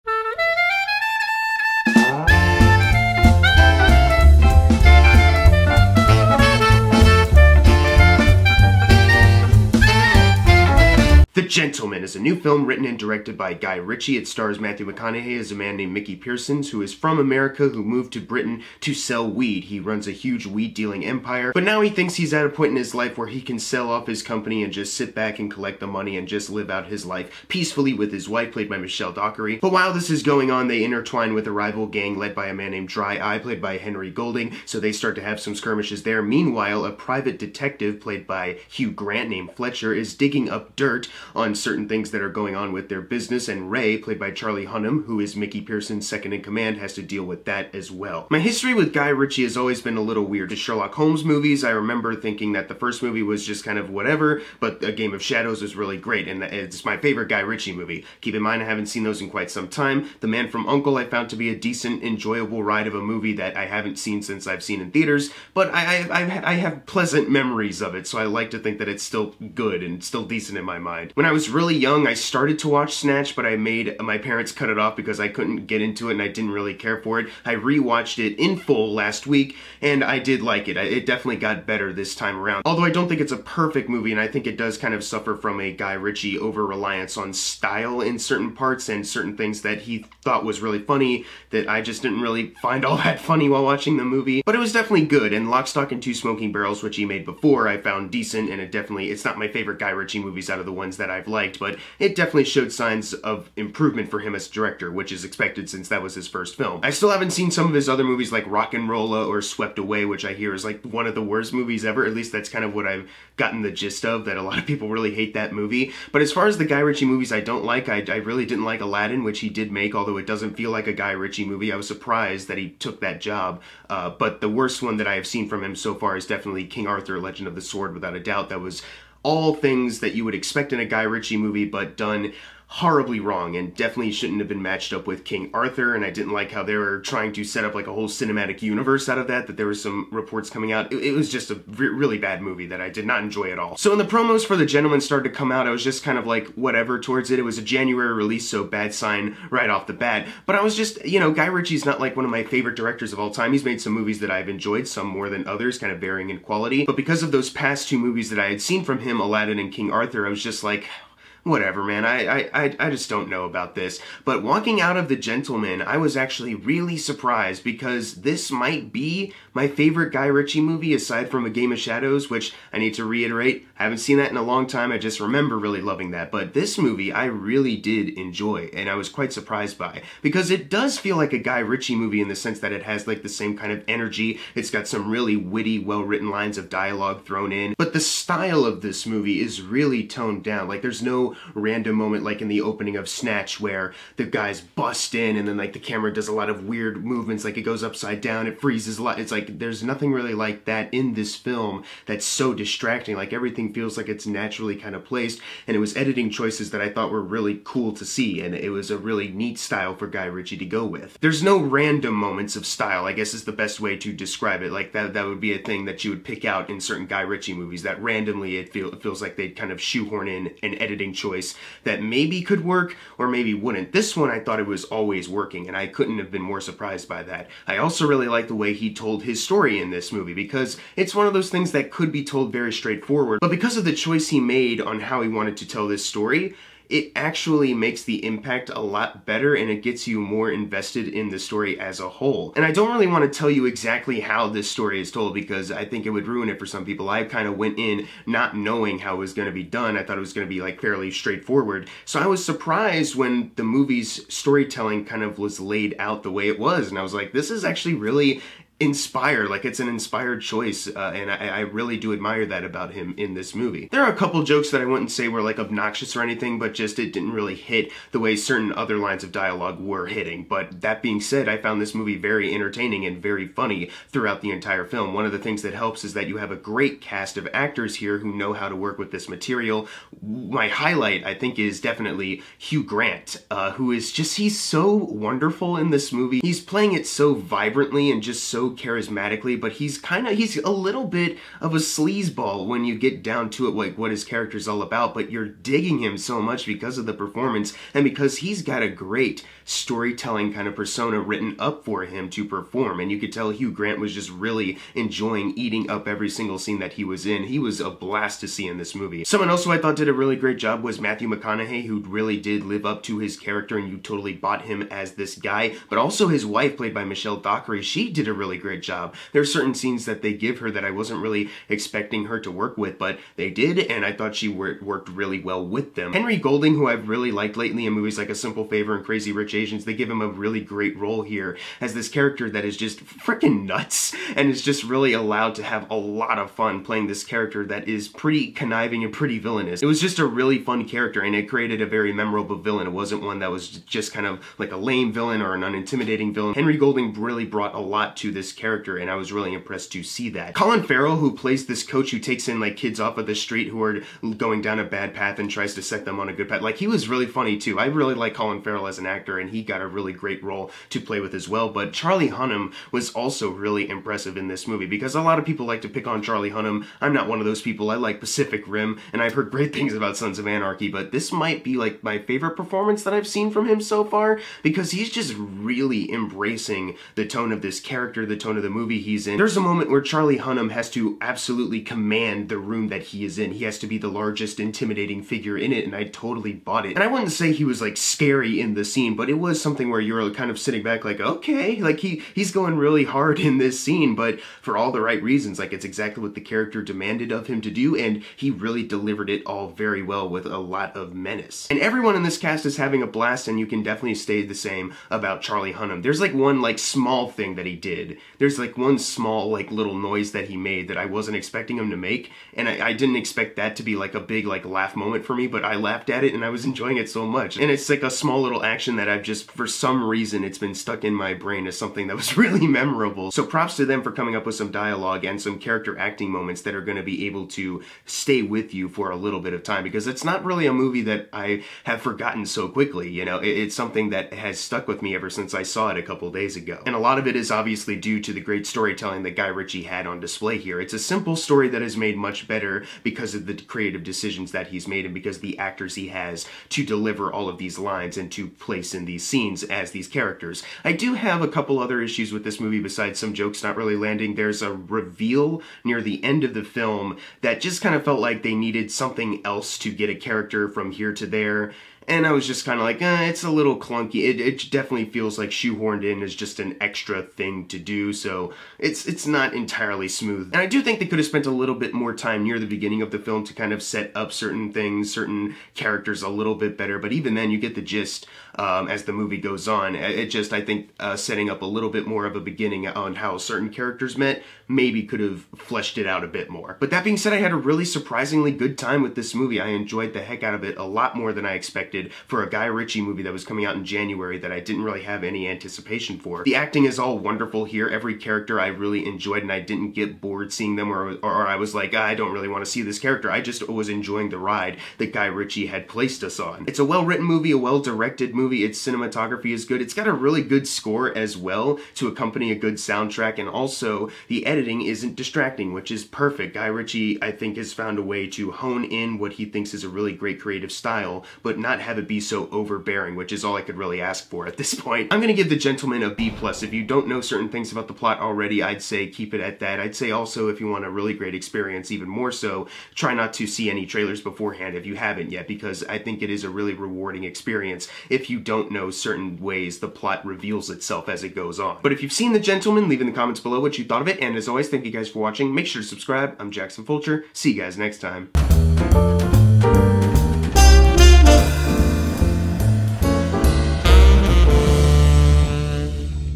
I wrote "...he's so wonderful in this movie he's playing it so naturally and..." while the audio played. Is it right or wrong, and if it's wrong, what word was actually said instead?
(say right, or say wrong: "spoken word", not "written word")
wrong: "vibrantly", not "naturally".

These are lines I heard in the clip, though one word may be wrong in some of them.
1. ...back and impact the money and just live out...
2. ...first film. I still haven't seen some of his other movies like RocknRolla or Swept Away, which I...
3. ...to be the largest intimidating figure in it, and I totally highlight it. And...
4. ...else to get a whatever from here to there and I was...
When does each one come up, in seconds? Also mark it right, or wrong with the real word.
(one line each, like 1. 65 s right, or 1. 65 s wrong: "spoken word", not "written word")
1. 25 s wrong: "collect", not "impact"
2. 106 s right
3. 383 s wrong: "bought", not "highlight"
4. 459 s wrong: "character", not "whatever".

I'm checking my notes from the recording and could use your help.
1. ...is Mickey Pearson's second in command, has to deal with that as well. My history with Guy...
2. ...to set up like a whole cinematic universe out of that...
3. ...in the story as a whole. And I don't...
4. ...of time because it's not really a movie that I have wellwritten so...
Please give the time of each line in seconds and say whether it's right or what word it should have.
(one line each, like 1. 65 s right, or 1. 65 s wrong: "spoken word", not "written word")
1. 45 s right
2. 137 s right
3. 241 s right
4. 429 s wrong: "forgotten", not "wellwritten".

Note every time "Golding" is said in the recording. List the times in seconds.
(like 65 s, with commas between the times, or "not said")
34 s, 326 s, 346 s.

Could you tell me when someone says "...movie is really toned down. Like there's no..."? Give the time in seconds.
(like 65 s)
189 s.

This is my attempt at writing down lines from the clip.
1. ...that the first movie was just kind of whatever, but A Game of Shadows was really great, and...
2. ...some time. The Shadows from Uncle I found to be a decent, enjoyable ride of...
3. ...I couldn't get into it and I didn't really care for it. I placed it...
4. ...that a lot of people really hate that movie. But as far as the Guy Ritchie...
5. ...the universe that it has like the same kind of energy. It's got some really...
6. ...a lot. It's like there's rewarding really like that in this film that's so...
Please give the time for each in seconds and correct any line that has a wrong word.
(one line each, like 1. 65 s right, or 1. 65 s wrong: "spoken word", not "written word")
1. 52 s right
2. 59 s wrong: "Man", not "Shadows"
3. 75 s wrong: "rewatched", not "placed"
4. 114 s right
5. 182 s wrong: "sense", not "universe"
6. 198 s wrong: "nothing", not "rewarding".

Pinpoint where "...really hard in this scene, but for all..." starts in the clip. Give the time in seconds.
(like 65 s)
392 s.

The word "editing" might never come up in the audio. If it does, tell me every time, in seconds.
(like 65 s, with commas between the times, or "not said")
205 s, 220 s, 514 s.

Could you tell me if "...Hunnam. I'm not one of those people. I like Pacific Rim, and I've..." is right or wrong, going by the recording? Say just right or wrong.
right.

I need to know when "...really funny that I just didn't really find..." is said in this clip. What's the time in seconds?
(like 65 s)
90 s.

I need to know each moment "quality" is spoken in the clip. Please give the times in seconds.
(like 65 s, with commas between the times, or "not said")
156 s.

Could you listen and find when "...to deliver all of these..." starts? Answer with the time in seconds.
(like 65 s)
446 s.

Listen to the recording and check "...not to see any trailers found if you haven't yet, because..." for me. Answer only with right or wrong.
wrong.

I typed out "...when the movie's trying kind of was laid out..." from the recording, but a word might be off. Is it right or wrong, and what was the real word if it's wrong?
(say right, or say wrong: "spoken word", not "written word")
wrong: "storytelling", not "trying".